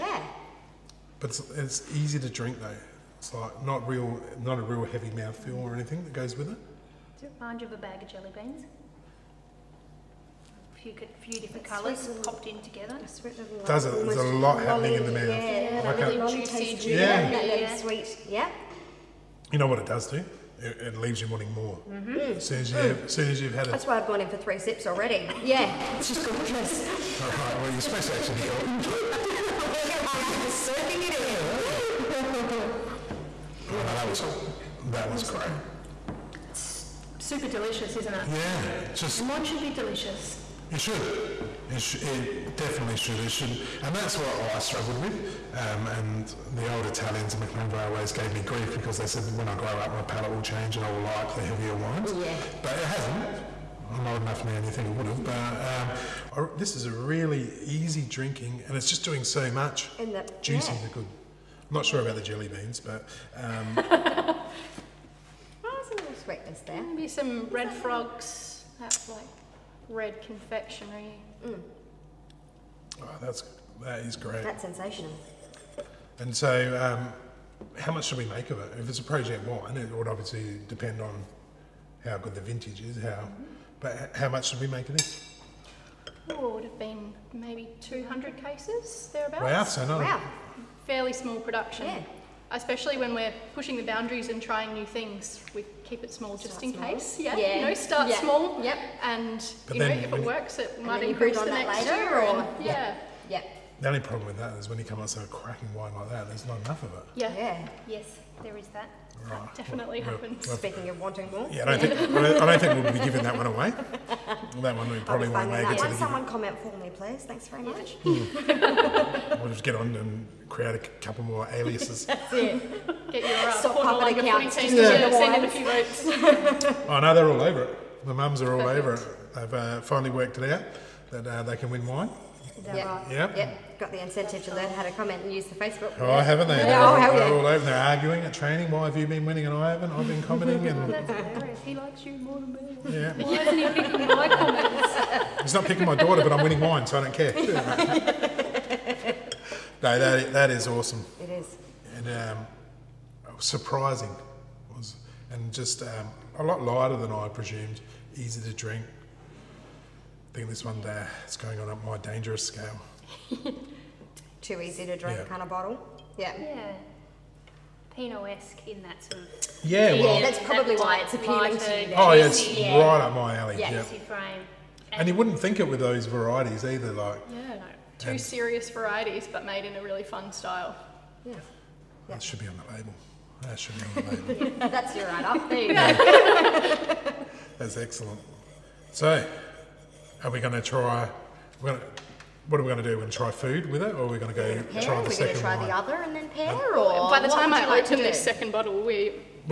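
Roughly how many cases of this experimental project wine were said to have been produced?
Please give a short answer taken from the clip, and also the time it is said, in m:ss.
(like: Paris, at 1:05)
200 cases, at 1:27.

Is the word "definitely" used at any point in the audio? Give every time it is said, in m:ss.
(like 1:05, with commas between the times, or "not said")
0:42, 1:49.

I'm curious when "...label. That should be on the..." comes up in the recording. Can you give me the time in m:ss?
3:02.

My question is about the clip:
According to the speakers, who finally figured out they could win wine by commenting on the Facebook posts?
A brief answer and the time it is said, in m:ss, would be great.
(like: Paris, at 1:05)
The mums, at 2:08.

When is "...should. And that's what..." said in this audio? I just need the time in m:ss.
0:43.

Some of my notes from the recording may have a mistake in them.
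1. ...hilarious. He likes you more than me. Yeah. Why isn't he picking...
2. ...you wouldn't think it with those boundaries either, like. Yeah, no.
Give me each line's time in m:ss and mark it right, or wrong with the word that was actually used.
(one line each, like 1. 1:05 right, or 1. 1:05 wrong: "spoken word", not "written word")
1. 2:21 right
2. 2:55 wrong: "varieties", not "boundaries".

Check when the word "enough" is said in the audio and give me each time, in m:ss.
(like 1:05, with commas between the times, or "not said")
0:54, 1:46.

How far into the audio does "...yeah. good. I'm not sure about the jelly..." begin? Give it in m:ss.
1:00.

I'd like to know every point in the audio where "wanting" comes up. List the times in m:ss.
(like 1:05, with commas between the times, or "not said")
0:21, 1:51.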